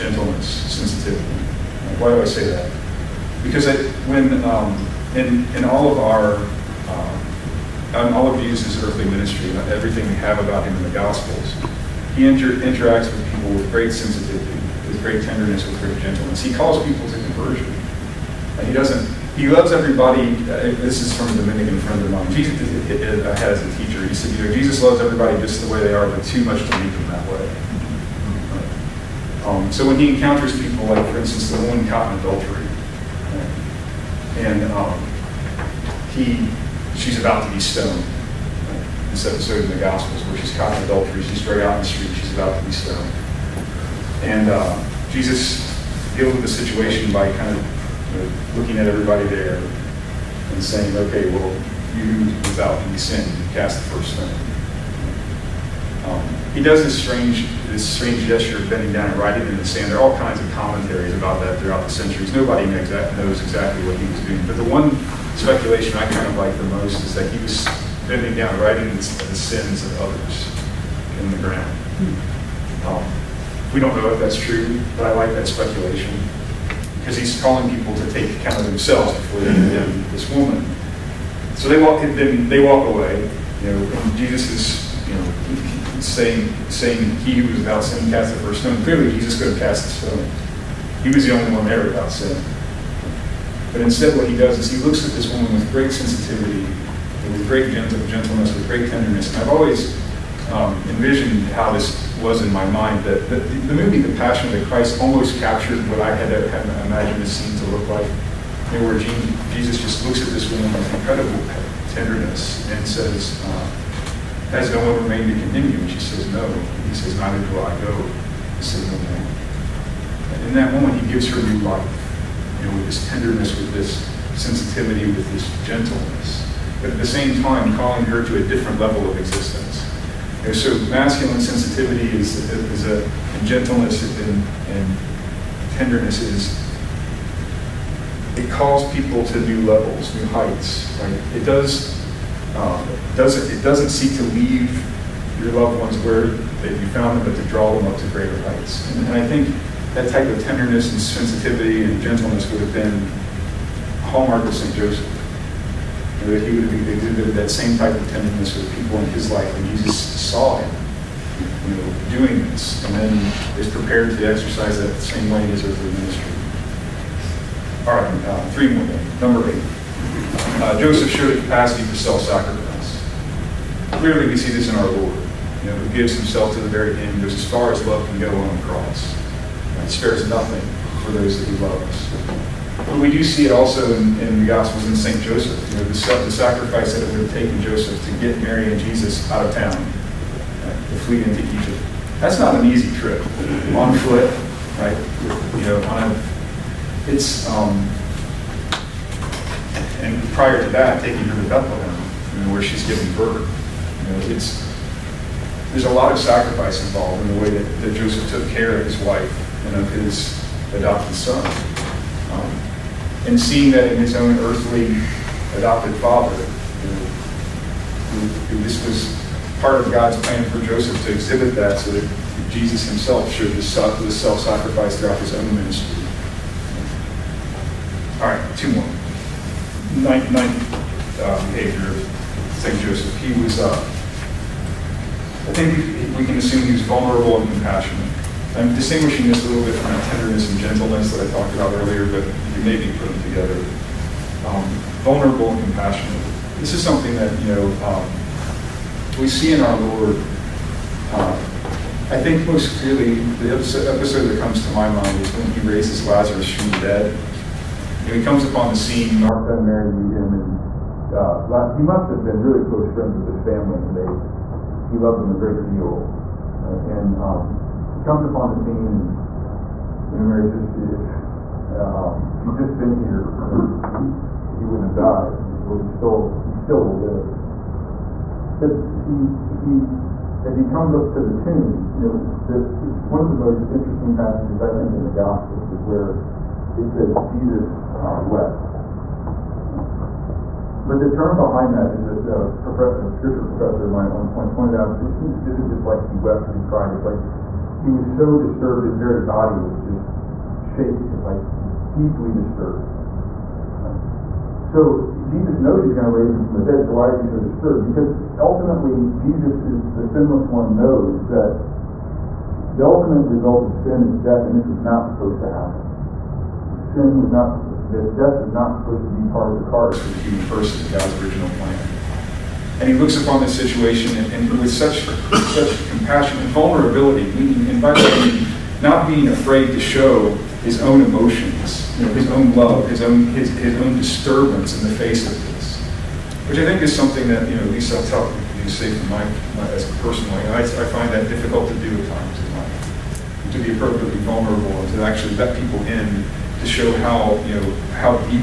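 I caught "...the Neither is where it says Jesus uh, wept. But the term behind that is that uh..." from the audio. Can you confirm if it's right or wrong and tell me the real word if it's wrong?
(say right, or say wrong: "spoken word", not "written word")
wrong: "Gospels", not "Neither".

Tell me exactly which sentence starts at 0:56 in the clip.
Um, he does this strange, this strange gesture of bending down and writing in the sand.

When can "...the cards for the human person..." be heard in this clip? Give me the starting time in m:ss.
5:19.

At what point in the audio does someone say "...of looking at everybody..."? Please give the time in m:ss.
0:47.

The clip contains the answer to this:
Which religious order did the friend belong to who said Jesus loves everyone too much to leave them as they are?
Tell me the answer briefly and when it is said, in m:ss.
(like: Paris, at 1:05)
Dominican, at 0:21.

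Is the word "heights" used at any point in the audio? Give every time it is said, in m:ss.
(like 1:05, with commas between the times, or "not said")
2:20, 2:28.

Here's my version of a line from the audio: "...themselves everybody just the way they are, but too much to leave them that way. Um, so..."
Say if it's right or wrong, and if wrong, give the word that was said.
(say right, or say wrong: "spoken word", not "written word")
wrong: "loves", not "themselves".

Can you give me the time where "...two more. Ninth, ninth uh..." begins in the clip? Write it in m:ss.
3:48.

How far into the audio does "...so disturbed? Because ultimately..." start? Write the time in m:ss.
5:07.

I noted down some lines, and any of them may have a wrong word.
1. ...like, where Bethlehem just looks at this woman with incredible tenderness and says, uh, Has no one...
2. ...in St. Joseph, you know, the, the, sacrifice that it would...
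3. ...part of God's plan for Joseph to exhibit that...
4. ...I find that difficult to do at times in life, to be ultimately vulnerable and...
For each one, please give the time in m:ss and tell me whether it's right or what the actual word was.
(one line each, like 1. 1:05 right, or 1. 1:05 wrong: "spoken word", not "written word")
1. 1:47 wrong: "Jesus", not "Bethlehem"
2. 3:04 right
3. 3:39 right
4. 5:40 wrong: "appropriately", not "ultimately".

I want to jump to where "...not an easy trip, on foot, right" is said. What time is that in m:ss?
3:12.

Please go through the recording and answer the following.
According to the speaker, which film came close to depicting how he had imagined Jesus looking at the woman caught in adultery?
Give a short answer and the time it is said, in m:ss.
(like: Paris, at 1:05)
The Passion of the Christ, at 1:43.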